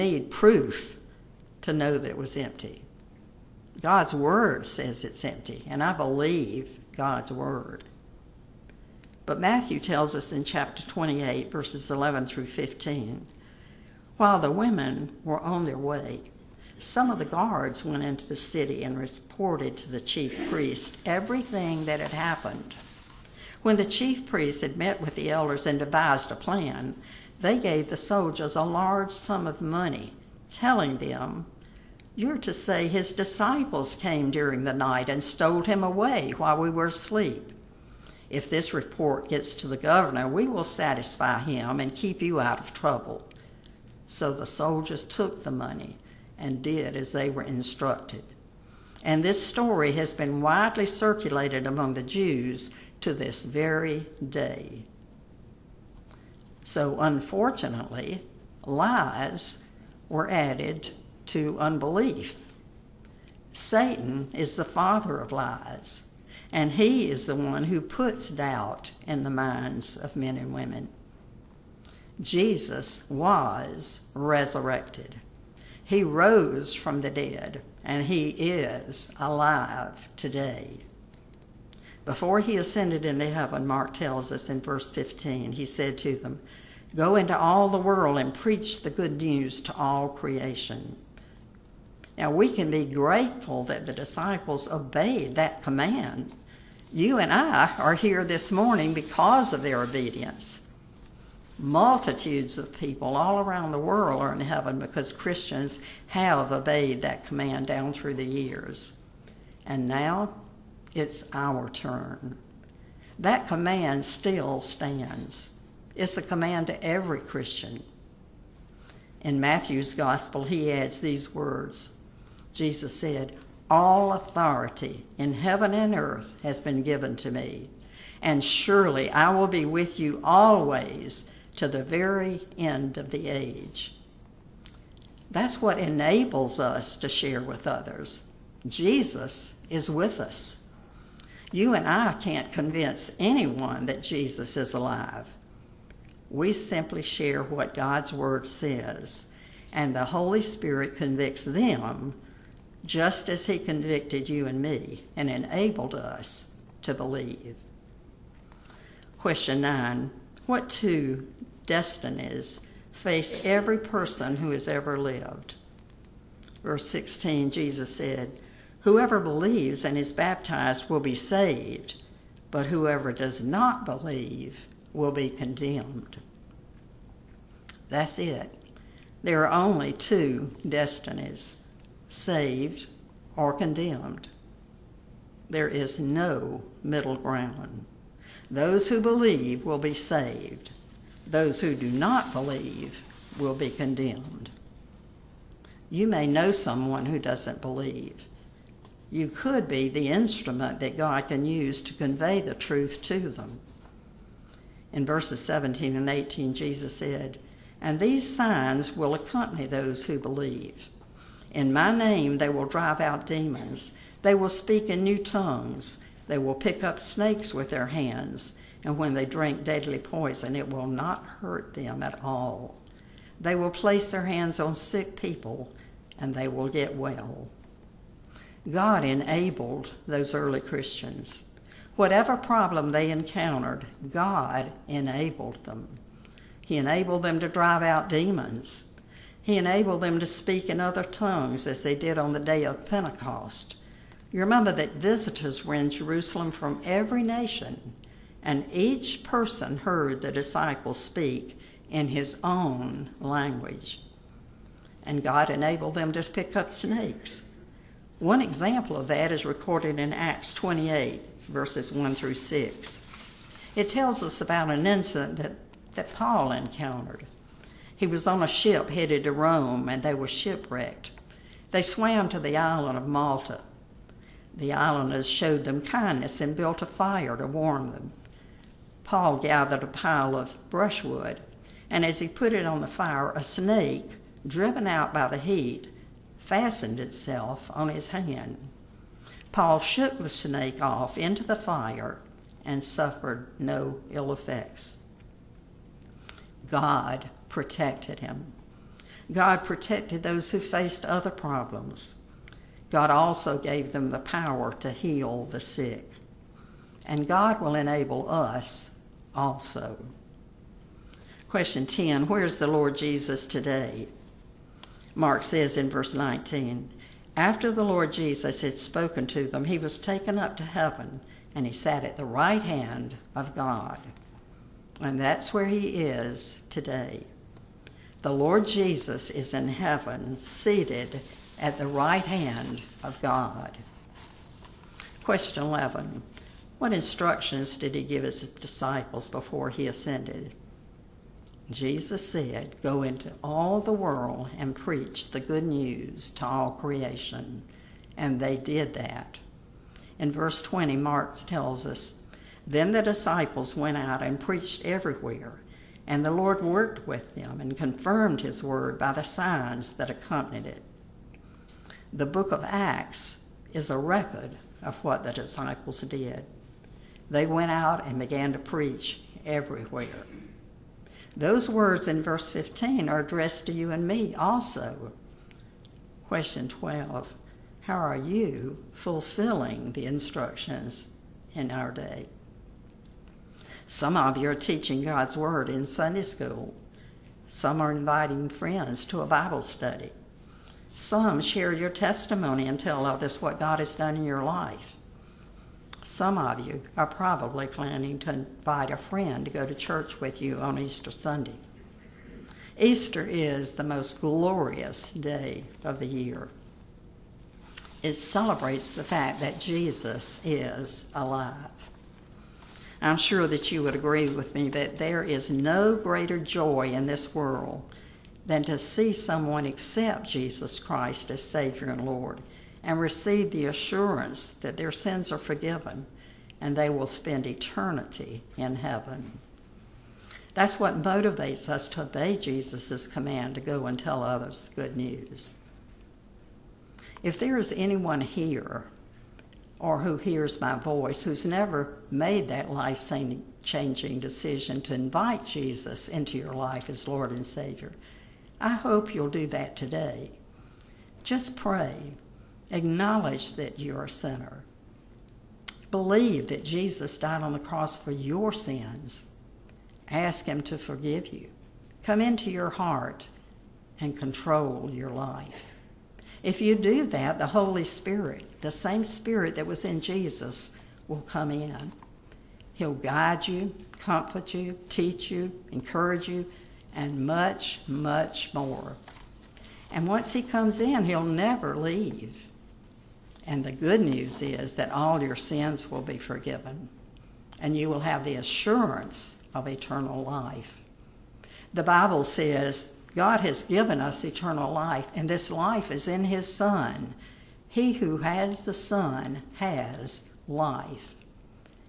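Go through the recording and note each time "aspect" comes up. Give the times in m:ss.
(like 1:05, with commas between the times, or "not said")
not said.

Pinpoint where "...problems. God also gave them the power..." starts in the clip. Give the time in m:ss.
5:01.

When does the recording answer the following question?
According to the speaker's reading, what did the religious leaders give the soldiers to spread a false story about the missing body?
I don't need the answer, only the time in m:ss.
0:28.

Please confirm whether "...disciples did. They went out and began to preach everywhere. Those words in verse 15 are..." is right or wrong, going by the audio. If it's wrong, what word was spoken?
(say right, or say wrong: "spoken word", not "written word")
right.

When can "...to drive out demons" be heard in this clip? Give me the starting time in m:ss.
3:57.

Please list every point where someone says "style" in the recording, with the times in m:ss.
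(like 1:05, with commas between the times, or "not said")
not said.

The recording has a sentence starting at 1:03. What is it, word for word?
Satan is the father of lies, and he is the one who puts doubt in the minds of men and women.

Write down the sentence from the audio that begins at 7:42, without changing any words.
Come into your heart and control your life.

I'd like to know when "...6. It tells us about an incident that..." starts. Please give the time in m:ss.
4:22.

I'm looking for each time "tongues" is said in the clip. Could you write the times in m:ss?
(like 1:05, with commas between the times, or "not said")
3:35, 4:01.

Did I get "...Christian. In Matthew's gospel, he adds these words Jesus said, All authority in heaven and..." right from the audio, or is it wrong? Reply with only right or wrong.
right.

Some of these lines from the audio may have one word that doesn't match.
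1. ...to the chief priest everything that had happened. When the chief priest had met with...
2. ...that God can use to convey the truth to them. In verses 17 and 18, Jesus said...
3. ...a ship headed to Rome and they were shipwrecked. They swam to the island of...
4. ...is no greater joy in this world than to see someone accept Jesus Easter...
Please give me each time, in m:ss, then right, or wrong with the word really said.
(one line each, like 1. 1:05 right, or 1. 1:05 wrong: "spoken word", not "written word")
1. 0:19 right
2. 3:20 right
3. 4:28 right
4. 6:55 wrong: "Christ", not "Easter".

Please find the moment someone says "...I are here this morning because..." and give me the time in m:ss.
1:37.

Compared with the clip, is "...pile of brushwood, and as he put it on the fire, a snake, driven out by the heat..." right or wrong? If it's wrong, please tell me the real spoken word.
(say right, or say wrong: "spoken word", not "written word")
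right.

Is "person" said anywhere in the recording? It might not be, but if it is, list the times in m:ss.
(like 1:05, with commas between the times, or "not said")
2:43, 4:09.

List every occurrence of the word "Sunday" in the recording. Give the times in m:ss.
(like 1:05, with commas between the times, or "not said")
6:25, 6:41.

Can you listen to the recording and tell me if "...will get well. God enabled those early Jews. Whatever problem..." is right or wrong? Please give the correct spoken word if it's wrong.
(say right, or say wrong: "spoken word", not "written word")
wrong: "Christians", not "Jews".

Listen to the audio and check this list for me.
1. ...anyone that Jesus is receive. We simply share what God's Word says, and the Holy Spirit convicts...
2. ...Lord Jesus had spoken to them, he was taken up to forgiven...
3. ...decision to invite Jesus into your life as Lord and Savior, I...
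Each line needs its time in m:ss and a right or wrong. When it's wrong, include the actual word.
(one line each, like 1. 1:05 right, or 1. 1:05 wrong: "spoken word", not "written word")
1. 2:23 wrong: "alive", not "receive"
2. 5:17 wrong: "heaven", not "forgiven"
3. 7:24 right.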